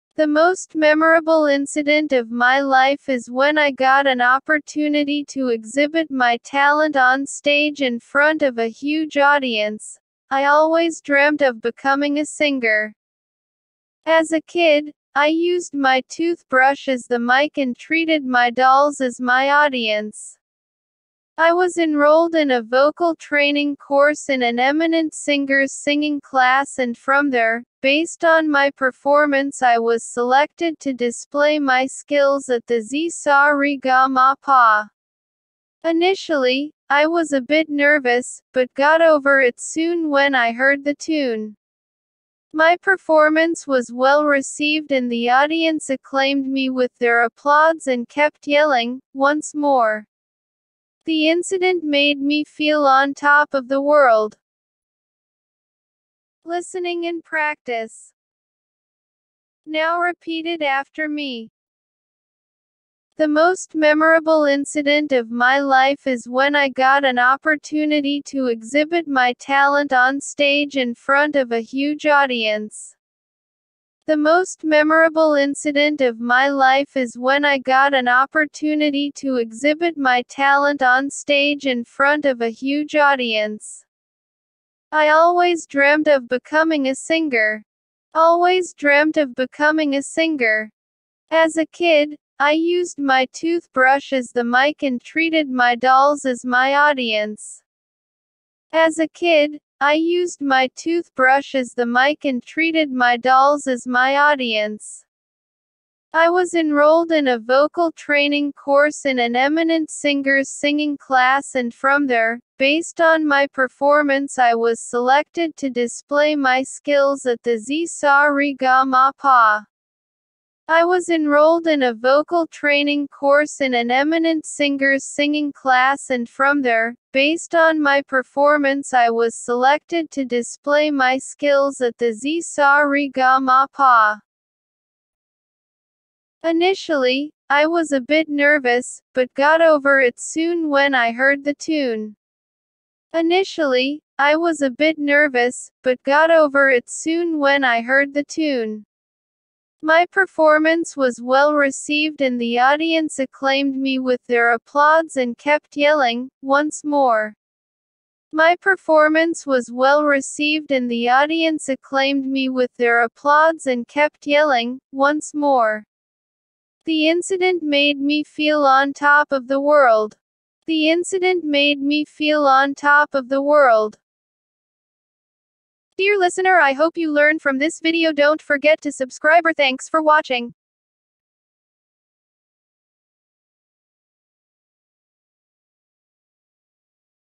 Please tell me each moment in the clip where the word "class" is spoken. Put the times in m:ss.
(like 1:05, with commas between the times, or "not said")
0:26, 1:50, 2:05.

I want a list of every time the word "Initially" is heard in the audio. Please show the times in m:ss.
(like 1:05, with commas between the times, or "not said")
0:35, 2:16, 2:23.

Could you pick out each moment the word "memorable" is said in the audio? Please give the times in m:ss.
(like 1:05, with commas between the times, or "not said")
0:00, 1:03, 1:14.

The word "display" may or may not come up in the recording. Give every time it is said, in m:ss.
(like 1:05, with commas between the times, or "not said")
0:30, 1:55, 2:10.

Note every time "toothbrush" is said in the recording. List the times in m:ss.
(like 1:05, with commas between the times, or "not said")
0:16, 1:33, 1:40.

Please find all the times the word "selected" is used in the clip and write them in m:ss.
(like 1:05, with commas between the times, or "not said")
0:30, 1:54, 2:09.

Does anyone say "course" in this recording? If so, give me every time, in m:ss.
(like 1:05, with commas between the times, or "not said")
0:23, 1:48, 2:03.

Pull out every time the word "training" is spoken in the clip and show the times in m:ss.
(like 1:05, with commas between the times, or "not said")
0:23, 1:47, 2:02.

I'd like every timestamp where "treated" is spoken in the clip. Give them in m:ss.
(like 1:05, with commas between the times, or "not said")
0:17, 1:35, 1:42.